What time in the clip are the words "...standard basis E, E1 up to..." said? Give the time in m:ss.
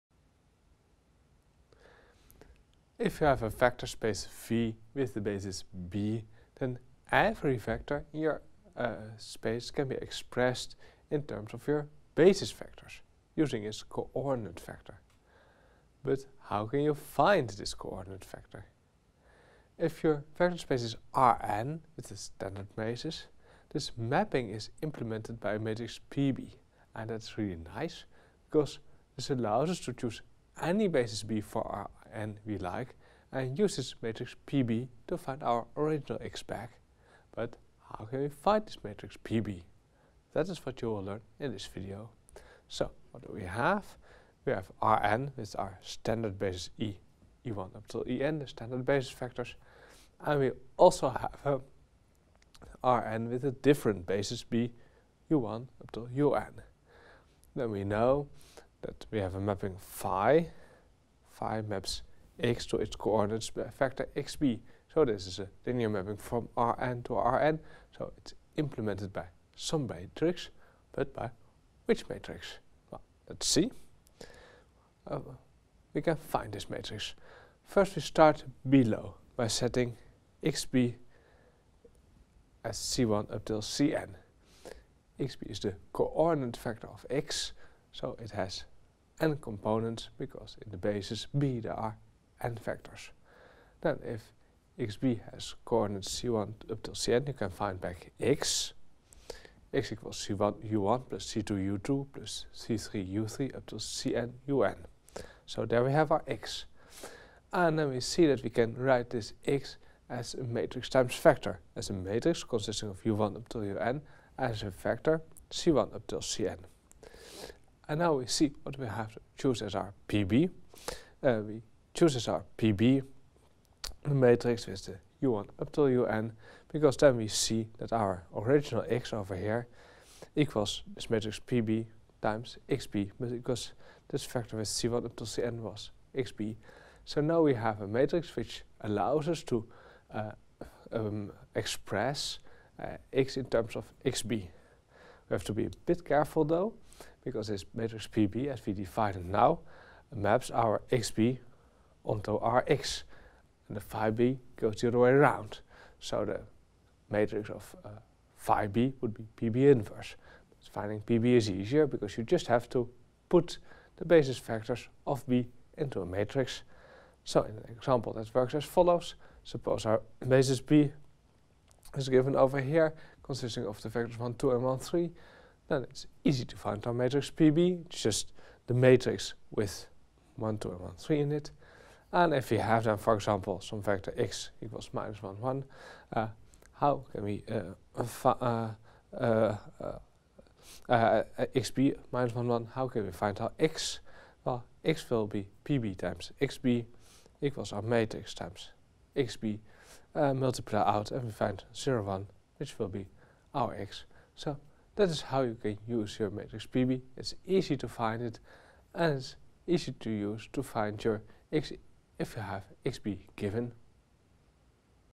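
0:45.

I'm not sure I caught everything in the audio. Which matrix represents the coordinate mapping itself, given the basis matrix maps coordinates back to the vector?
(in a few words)
PB inverse.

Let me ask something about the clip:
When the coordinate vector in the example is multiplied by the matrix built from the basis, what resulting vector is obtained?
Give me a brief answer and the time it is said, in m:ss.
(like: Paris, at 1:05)
0, 1, at 3:21.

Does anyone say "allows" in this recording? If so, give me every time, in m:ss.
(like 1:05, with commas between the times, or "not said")
0:29, 2:18.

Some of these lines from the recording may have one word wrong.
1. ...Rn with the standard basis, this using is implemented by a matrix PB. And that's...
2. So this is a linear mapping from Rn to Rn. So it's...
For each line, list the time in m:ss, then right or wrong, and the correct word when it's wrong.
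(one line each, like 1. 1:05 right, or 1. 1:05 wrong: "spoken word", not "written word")
1. 0:21 wrong: "mapping", not "using"
2. 1:04 right.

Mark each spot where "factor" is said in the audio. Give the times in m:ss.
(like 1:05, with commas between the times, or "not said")
2:14.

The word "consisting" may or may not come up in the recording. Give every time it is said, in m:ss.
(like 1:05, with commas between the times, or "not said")
1:52, 2:53.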